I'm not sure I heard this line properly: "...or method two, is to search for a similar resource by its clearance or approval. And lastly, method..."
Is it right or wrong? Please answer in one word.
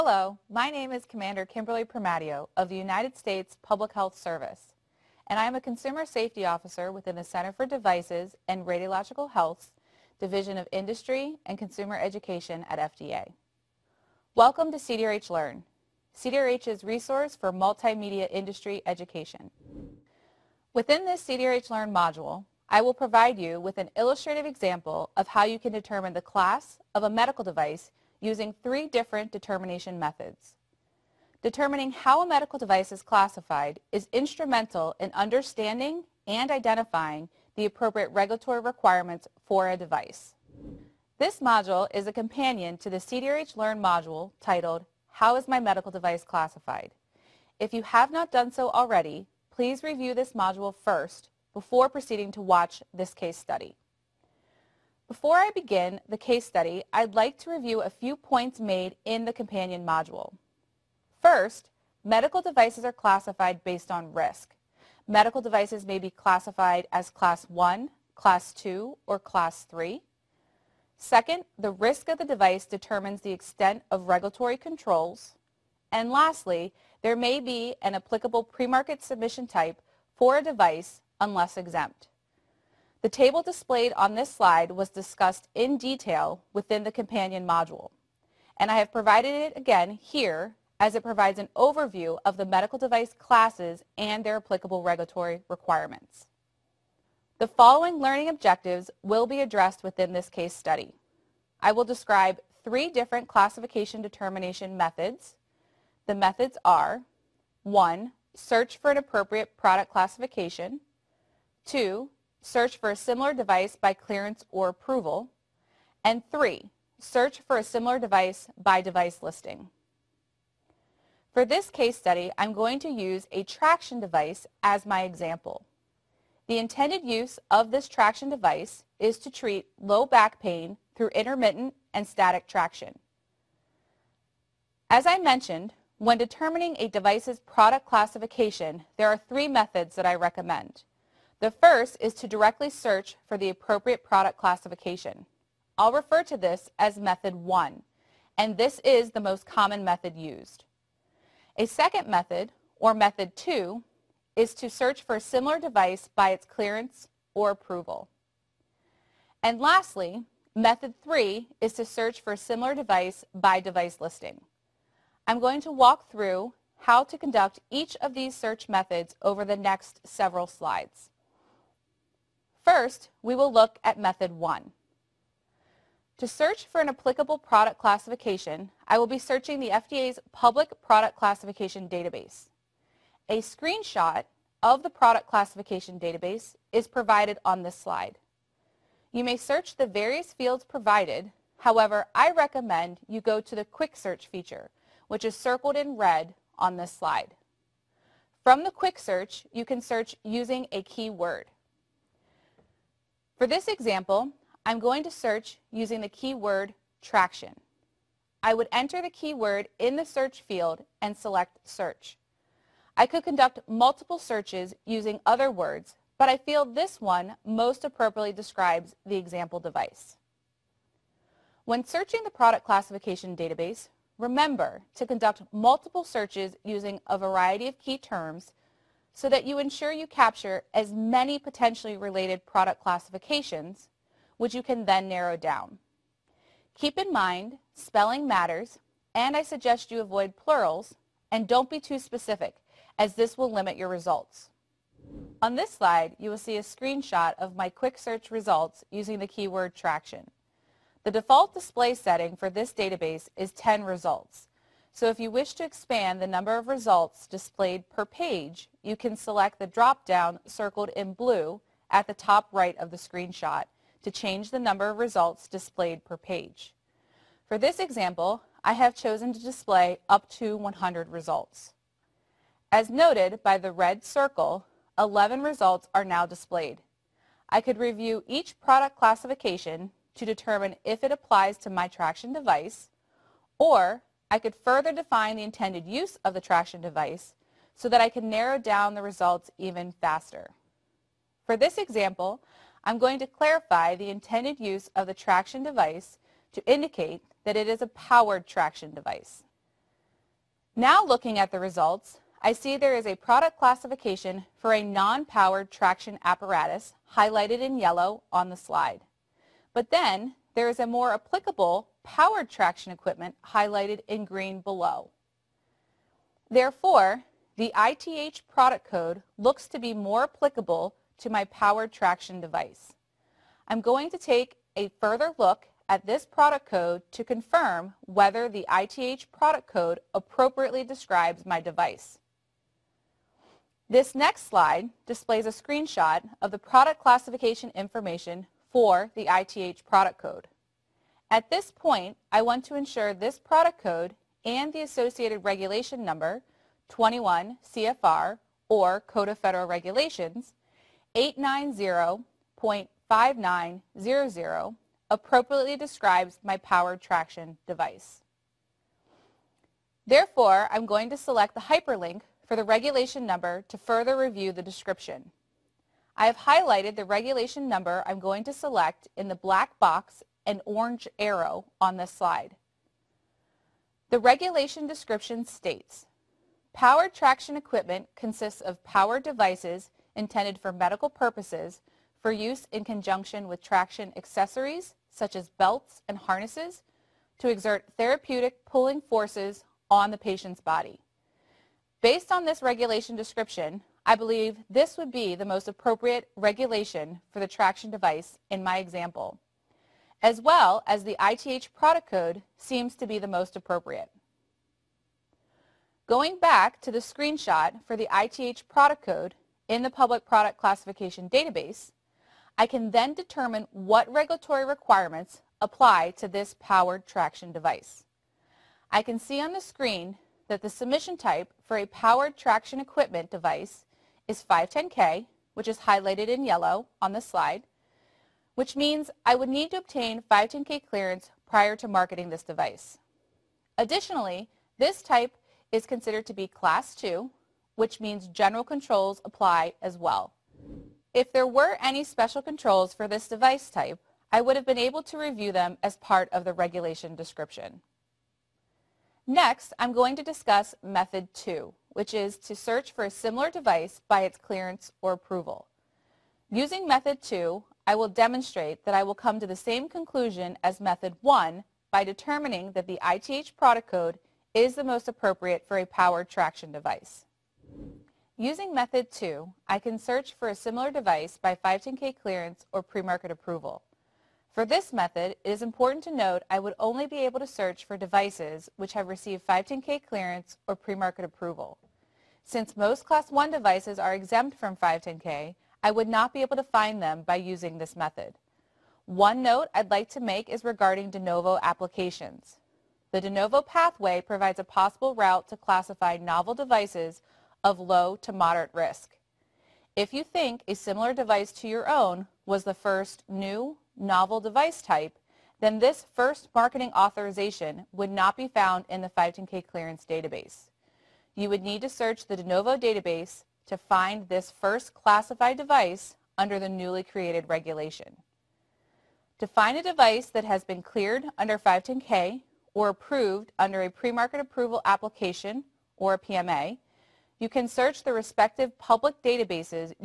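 wrong.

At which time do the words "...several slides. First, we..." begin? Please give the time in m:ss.
2:50.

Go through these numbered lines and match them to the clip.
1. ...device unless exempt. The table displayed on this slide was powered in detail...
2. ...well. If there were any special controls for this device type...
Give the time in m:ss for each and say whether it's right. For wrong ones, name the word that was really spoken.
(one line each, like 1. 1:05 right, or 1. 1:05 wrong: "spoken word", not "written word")
1. 1:20 wrong: "discussed", not "powered"
2. 7:19 right.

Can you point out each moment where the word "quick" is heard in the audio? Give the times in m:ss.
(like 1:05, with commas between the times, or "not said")
3:13, 3:18, 4:07.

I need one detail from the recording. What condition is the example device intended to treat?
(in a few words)
low back pain.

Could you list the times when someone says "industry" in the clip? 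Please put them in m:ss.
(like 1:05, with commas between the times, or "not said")
0:10, 0:18.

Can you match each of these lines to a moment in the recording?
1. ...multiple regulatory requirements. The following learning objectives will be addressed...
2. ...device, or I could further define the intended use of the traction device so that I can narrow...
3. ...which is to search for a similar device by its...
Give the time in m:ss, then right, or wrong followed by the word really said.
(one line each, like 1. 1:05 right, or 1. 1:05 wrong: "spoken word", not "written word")
1. 1:34 wrong: "applicable", not "multiple"
2. 4:42 right
3. 7:31 right.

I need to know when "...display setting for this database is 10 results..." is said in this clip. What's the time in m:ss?
4:11.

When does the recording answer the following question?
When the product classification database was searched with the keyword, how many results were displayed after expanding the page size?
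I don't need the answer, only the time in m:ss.
4:34.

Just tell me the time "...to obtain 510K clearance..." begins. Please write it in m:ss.
7:09.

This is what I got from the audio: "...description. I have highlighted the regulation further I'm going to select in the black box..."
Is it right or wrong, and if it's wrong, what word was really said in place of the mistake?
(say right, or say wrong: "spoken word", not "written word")
wrong: "number", not "further".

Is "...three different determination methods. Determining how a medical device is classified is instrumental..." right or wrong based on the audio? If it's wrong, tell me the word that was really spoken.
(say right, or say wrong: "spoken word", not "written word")
right.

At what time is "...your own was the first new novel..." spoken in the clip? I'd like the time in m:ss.
8:21.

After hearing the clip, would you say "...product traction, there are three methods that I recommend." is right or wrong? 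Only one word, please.
wrong.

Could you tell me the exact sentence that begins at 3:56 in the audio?
Keep in mind, spelling matters, and I suggest you avoid plurals, and don't be too specific, as this will limit your results.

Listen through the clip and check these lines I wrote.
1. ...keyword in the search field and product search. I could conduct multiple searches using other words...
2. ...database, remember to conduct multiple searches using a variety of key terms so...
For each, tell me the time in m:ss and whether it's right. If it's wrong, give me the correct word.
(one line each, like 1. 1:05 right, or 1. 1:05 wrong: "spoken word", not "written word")
1. 3:29 wrong: "select", not "product"
2. 3:43 right.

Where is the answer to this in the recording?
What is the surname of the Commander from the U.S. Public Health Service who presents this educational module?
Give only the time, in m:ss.
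0:01.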